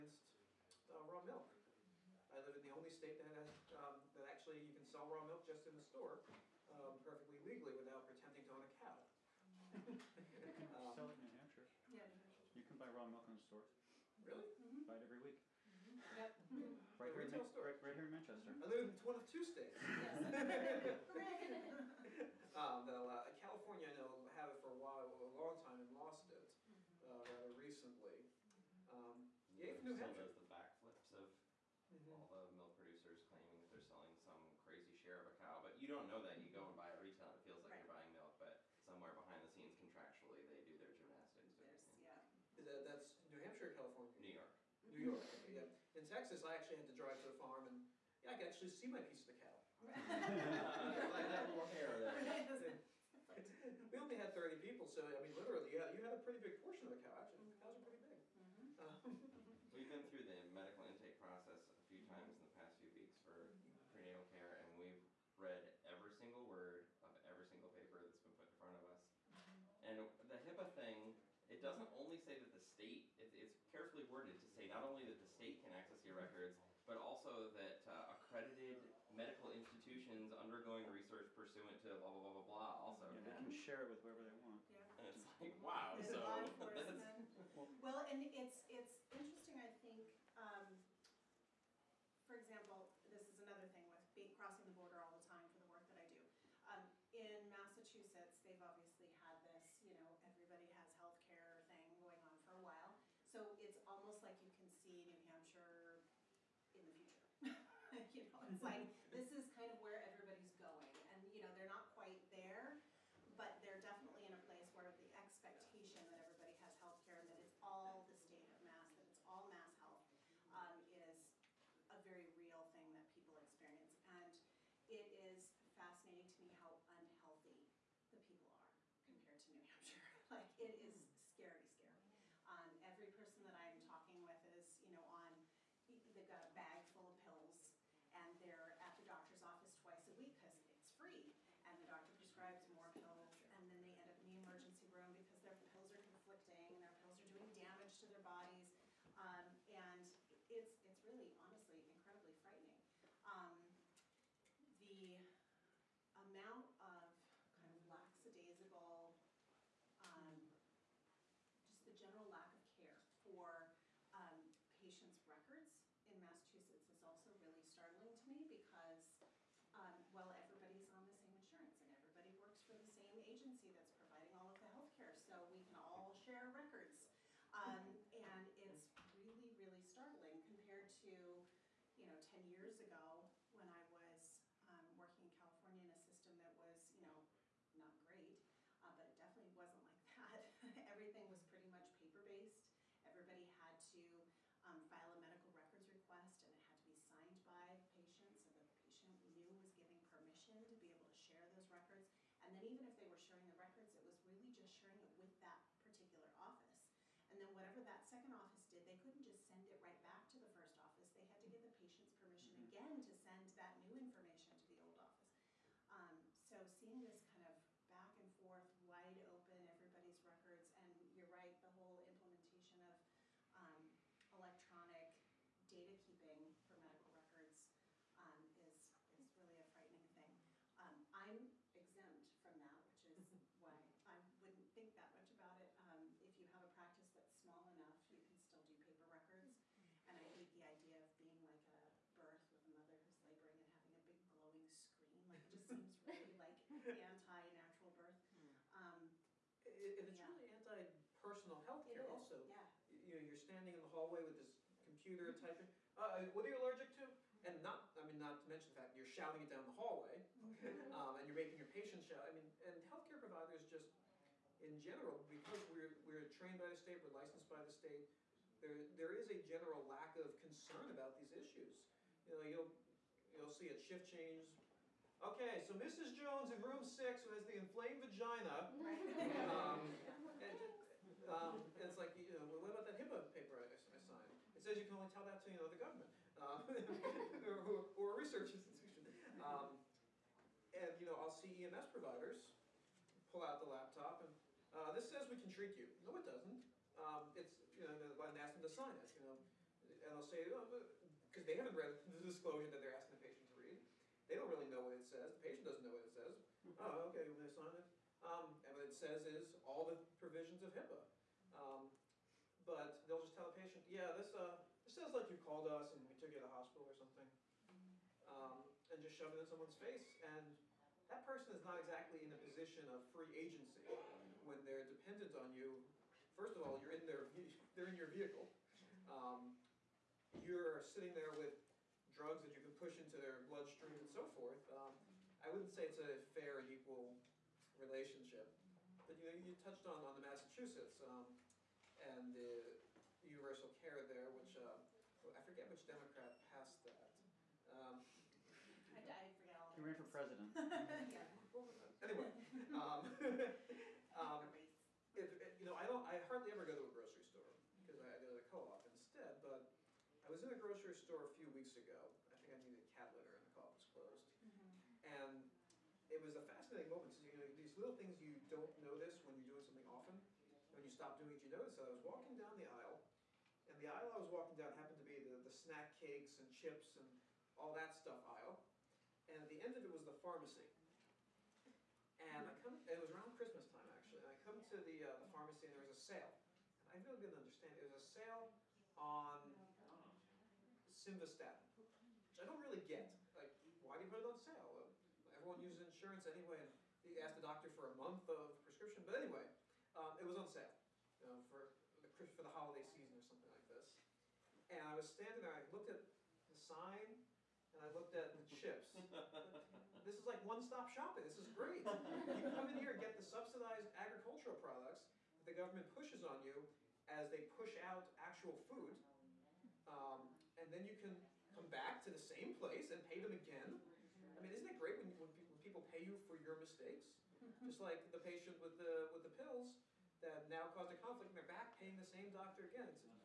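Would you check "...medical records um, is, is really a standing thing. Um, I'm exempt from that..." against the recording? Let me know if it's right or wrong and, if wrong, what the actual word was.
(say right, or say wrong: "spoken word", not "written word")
wrong: "frightening", not "standing".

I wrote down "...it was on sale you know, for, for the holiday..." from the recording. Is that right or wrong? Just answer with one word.
right.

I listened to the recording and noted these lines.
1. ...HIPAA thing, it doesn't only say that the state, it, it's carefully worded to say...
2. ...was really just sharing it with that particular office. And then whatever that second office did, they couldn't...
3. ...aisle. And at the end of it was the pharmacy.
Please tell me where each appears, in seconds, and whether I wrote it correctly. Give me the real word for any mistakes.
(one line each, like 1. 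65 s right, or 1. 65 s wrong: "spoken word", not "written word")
1. 70 s right
2. 204 s right
3. 378 s right.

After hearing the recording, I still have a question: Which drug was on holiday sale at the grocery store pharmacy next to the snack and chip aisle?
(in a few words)
Simvastatin.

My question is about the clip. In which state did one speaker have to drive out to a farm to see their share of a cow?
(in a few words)
Texas.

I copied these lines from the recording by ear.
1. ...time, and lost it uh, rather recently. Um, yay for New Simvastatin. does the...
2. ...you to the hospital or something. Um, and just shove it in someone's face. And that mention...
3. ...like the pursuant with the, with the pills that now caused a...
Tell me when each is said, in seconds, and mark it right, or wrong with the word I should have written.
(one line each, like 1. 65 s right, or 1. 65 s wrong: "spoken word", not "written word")
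1. 25 s wrong: "Hampshire", not "Simvastatin"
2. 316 s wrong: "person", not "mention"
3. 427 s wrong: "patient", not "pursuant".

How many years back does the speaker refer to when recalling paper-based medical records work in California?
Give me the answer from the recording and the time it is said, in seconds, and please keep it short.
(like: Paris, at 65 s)
10, at 182 s.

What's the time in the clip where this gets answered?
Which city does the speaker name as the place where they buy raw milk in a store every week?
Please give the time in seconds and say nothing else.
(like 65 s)
18 s.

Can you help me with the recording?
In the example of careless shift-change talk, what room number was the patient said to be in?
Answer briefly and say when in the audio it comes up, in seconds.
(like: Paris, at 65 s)
6, at 276 s.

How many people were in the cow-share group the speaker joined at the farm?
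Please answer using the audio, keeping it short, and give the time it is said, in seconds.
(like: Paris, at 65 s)
30, at 54 s.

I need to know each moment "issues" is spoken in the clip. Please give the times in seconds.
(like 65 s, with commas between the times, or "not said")
271 s.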